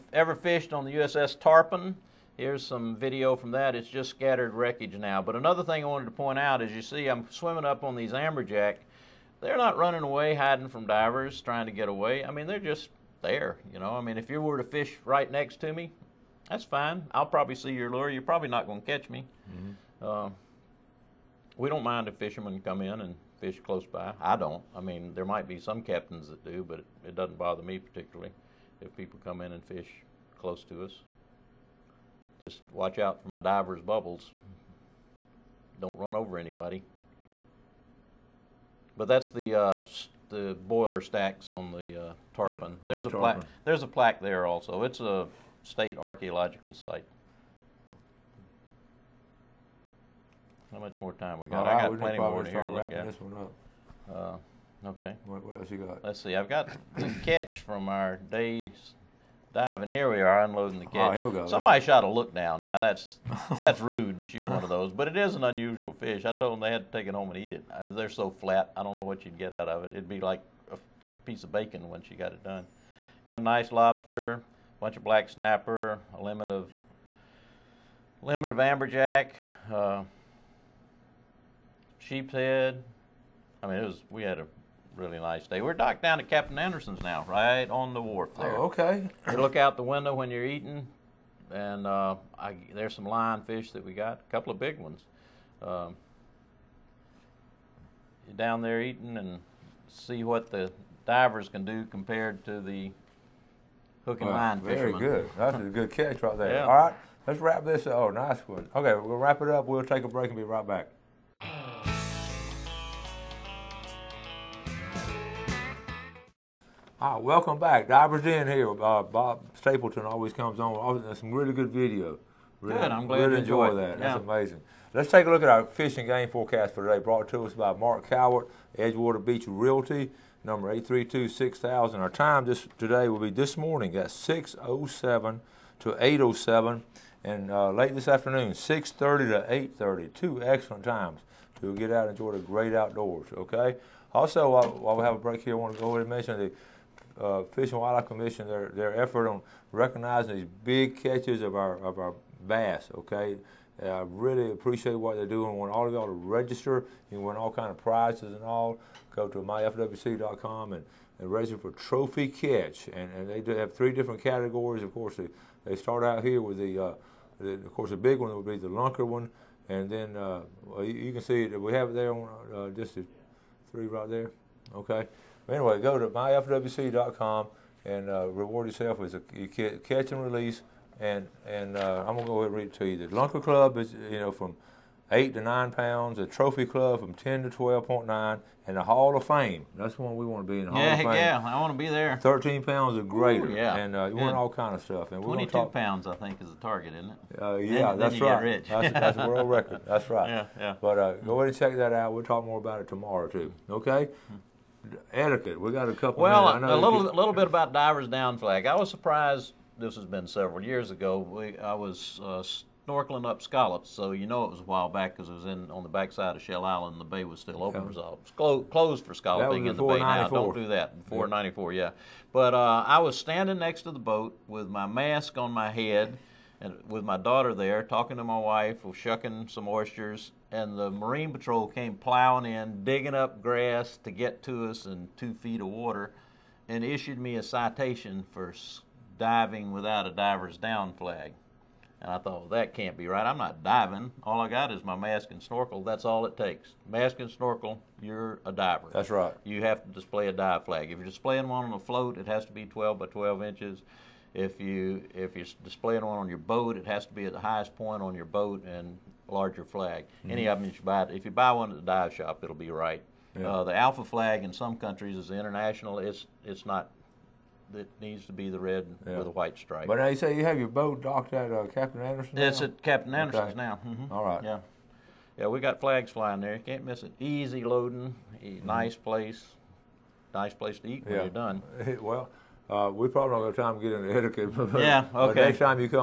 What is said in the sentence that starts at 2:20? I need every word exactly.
Two excellent times to get out and enjoy the great outdoors.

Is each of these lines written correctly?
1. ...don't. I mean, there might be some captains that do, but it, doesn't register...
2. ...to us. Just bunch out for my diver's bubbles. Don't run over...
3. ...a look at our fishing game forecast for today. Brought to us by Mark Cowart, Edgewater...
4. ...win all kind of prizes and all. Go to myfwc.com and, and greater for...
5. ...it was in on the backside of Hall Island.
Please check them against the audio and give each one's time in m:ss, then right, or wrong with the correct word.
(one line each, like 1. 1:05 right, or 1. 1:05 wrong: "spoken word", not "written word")
1. 0:24 wrong: "bother", not "register"
2. 0:30 wrong: "watch", not "bunch"
3. 2:05 right
4. 2:37 wrong: "register", not "greater"
5. 3:35 wrong: "Shell", not "Hall".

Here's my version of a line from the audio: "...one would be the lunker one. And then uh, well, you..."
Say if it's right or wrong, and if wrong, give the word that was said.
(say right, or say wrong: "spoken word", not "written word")
right.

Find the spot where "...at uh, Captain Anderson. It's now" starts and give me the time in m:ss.
4:31.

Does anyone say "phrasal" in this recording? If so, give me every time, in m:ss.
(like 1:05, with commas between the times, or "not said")
not said.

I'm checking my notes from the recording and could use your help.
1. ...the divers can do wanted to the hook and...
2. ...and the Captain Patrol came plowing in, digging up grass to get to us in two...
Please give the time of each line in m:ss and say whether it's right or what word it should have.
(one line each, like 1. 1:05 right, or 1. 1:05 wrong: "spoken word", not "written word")
1. 1:40 wrong: "compared", not "wanted"
2. 3:50 wrong: "Marine", not "Captain".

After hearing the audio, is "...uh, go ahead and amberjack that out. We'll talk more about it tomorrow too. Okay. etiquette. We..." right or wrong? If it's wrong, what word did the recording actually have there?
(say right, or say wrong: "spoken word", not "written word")
wrong: "check", not "amberjack".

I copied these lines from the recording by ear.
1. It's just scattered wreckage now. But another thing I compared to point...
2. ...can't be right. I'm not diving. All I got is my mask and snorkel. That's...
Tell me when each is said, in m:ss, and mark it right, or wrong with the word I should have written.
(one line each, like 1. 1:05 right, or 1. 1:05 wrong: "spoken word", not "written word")
1. 0:03 wrong: "wanted", not "compared"
2. 4:02 right.